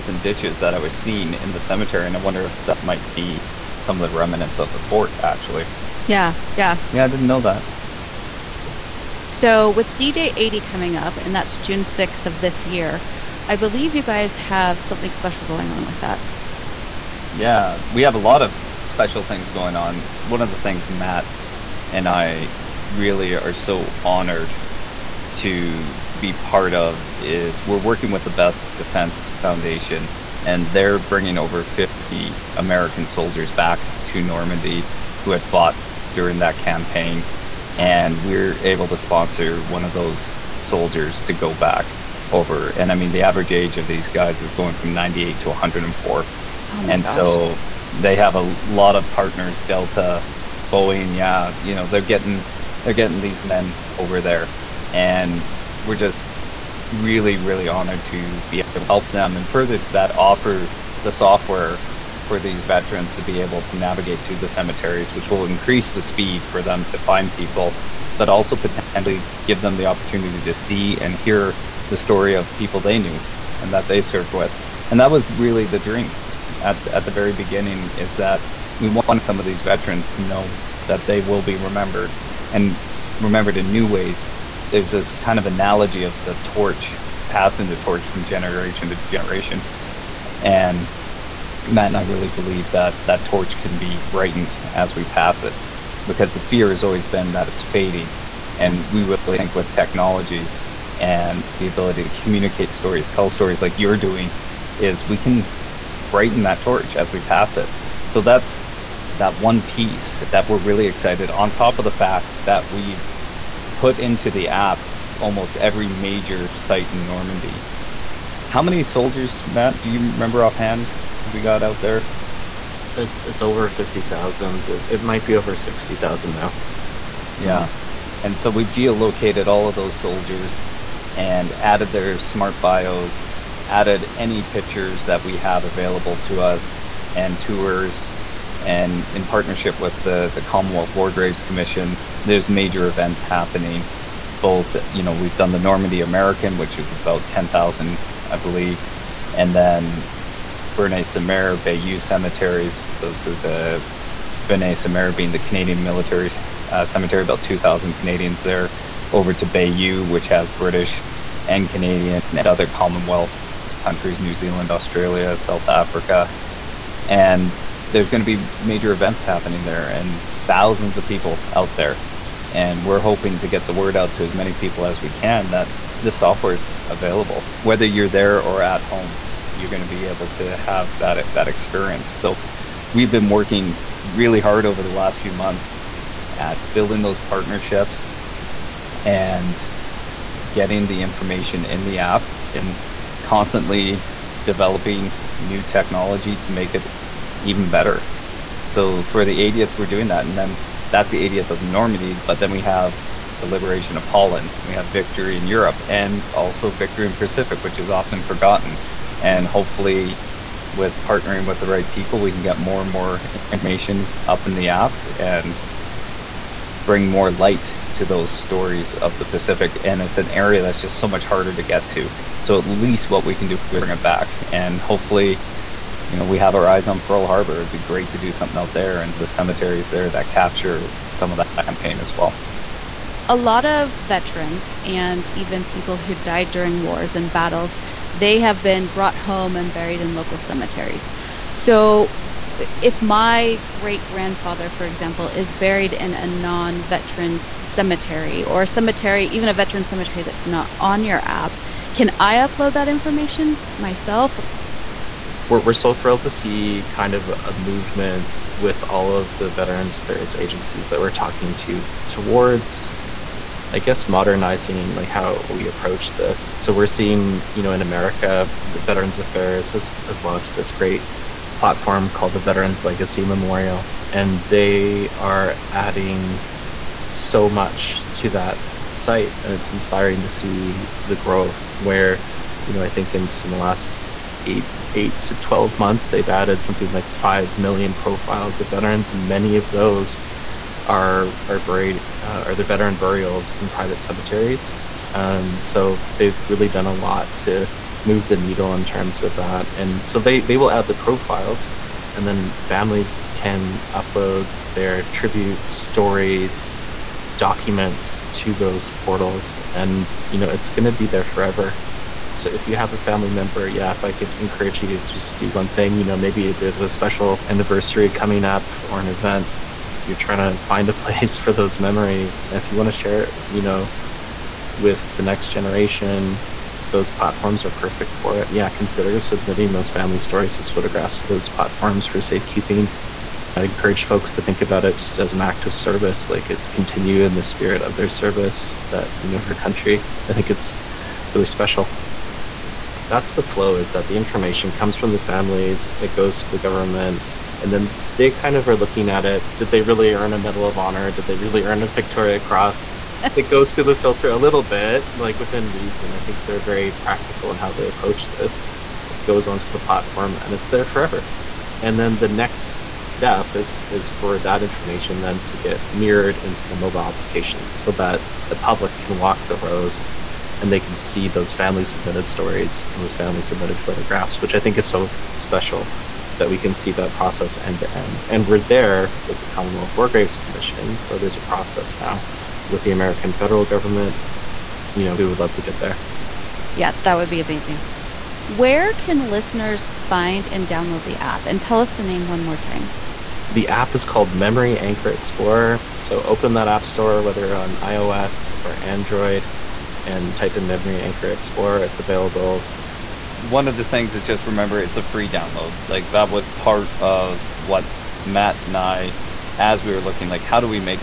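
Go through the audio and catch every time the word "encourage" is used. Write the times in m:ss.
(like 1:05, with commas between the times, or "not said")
5:14, 5:33.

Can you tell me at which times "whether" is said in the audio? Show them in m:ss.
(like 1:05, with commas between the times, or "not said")
2:57, 6:37.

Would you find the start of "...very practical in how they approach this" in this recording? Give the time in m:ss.
5:56.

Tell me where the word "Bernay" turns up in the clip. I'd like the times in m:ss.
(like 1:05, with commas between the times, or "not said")
2:30.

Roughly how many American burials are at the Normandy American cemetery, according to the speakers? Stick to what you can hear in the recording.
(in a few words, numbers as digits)
10,000.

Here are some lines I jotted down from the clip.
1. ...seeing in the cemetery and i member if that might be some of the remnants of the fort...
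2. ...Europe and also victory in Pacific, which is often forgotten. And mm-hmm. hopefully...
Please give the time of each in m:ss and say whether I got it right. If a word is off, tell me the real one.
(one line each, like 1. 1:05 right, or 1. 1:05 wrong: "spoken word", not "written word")
1. 0:00 wrong: "wonder", not "member"
2. 3:25 right.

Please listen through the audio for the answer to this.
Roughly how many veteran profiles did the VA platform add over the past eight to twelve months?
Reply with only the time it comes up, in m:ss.
4:47.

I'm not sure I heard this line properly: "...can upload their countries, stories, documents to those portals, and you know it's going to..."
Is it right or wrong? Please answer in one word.
wrong.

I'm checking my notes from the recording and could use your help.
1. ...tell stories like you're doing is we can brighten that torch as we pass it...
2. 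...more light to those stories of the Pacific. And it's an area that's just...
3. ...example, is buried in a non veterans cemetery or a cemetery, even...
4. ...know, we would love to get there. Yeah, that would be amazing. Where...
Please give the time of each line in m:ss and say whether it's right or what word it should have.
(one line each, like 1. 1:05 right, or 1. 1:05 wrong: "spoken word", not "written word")
1. 1:43 right
2. 3:37 right
3. 4:04 right
4. 6:25 right.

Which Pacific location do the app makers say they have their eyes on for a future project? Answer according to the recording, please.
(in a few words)
Pearl Harbor.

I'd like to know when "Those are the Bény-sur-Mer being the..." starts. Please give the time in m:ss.
2:32.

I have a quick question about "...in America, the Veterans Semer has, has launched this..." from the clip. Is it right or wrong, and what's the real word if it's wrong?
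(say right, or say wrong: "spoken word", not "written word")
wrong: "Affairs", not "Semer".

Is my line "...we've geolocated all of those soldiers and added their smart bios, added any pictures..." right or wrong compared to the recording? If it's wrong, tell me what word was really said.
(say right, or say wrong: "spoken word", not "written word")
right.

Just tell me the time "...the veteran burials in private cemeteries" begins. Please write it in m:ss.
4:52.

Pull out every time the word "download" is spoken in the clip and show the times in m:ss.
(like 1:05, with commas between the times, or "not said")
6:30, 6:45.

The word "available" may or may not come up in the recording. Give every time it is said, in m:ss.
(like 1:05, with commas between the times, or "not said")
2:15, 2:56, 6:41.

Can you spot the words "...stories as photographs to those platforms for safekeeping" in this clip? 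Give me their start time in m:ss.
5:30.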